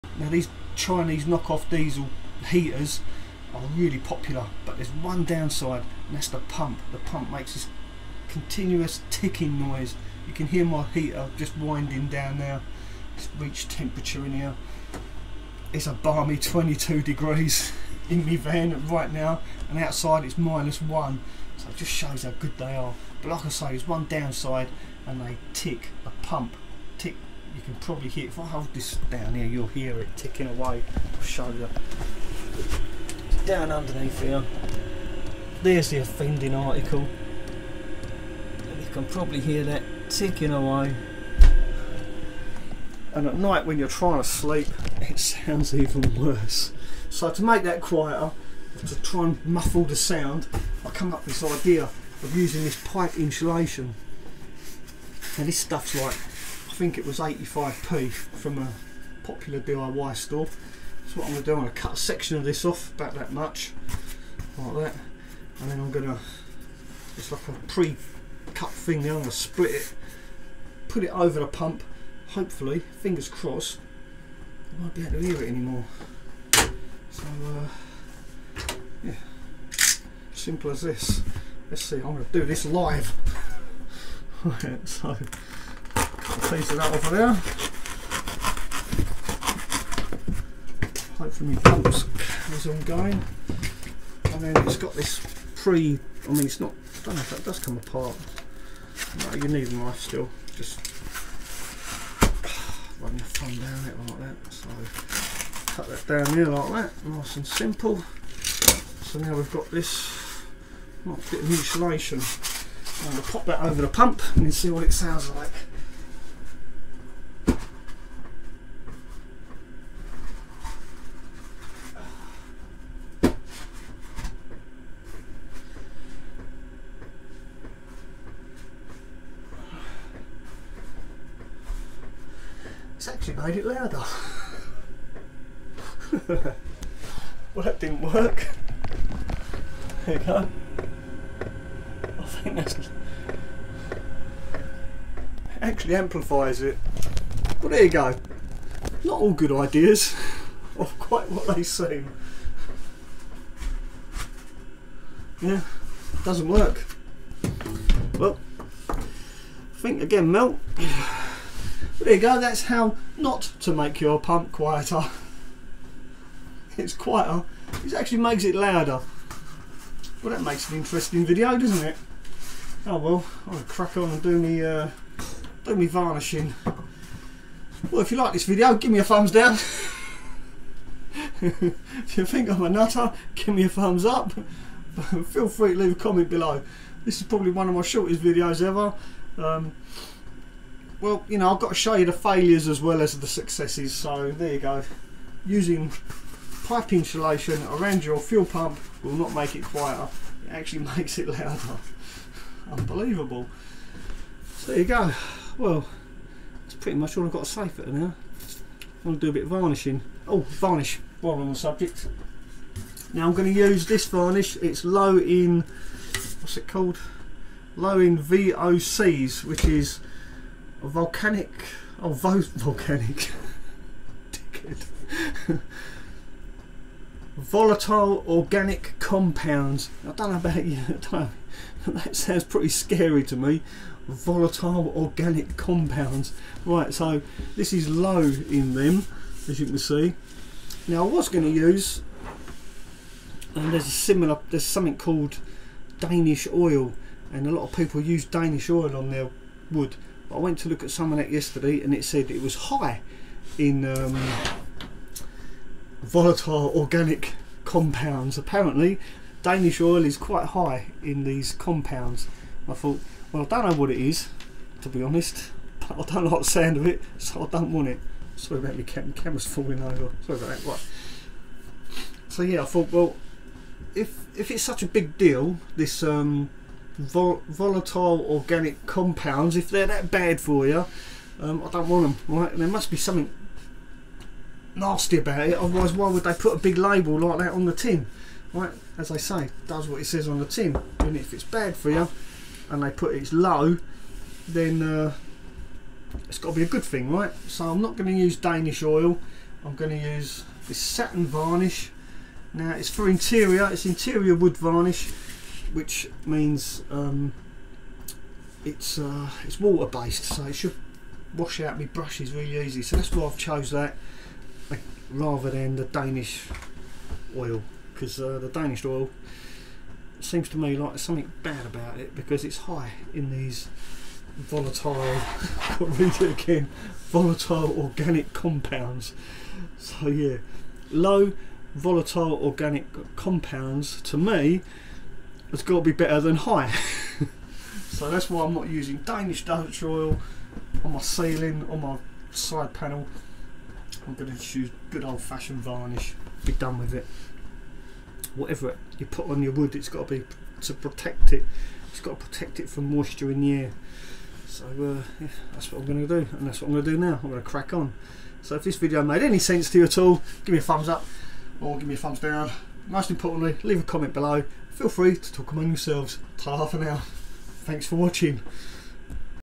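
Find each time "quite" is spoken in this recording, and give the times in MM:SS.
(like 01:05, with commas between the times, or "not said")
02:30, 04:20.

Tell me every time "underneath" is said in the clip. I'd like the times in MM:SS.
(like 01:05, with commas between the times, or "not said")
00:33.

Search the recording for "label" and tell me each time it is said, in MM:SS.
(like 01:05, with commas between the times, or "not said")
04:46.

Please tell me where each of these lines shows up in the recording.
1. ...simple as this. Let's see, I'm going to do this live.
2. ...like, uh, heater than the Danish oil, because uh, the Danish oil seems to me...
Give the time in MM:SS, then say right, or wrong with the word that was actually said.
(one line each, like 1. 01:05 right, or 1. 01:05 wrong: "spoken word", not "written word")
1. 01:20 right
2. 05:14 wrong: "rather", not "heater".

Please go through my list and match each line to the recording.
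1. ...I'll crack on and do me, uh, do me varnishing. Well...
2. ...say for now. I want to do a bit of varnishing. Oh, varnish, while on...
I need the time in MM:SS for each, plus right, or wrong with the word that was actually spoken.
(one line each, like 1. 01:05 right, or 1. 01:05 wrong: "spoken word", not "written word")
1. 02:53 right
2. 03:27 right.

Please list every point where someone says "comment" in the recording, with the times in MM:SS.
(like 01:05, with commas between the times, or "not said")
03:05, 06:03.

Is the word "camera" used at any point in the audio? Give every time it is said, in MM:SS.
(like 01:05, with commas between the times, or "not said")
04:29.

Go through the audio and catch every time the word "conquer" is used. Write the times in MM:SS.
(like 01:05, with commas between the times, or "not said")
not said.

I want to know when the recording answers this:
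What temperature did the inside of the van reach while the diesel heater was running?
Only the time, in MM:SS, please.
00:16.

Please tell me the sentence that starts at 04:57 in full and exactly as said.
So I'm not going to use Danish oil.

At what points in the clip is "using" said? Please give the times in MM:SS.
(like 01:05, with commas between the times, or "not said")
00:52, 03:15, 05:38.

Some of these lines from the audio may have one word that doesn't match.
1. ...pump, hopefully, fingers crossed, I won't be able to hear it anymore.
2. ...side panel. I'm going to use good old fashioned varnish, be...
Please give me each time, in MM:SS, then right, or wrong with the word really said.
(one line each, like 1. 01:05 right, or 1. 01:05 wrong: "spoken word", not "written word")
1. 01:11 right
2. 05:42 right.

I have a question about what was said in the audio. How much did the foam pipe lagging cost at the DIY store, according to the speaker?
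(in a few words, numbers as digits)
85p.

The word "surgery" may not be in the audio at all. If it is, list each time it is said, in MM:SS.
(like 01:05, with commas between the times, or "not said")
not said.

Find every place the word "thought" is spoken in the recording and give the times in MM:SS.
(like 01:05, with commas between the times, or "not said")
04:22, 04:32.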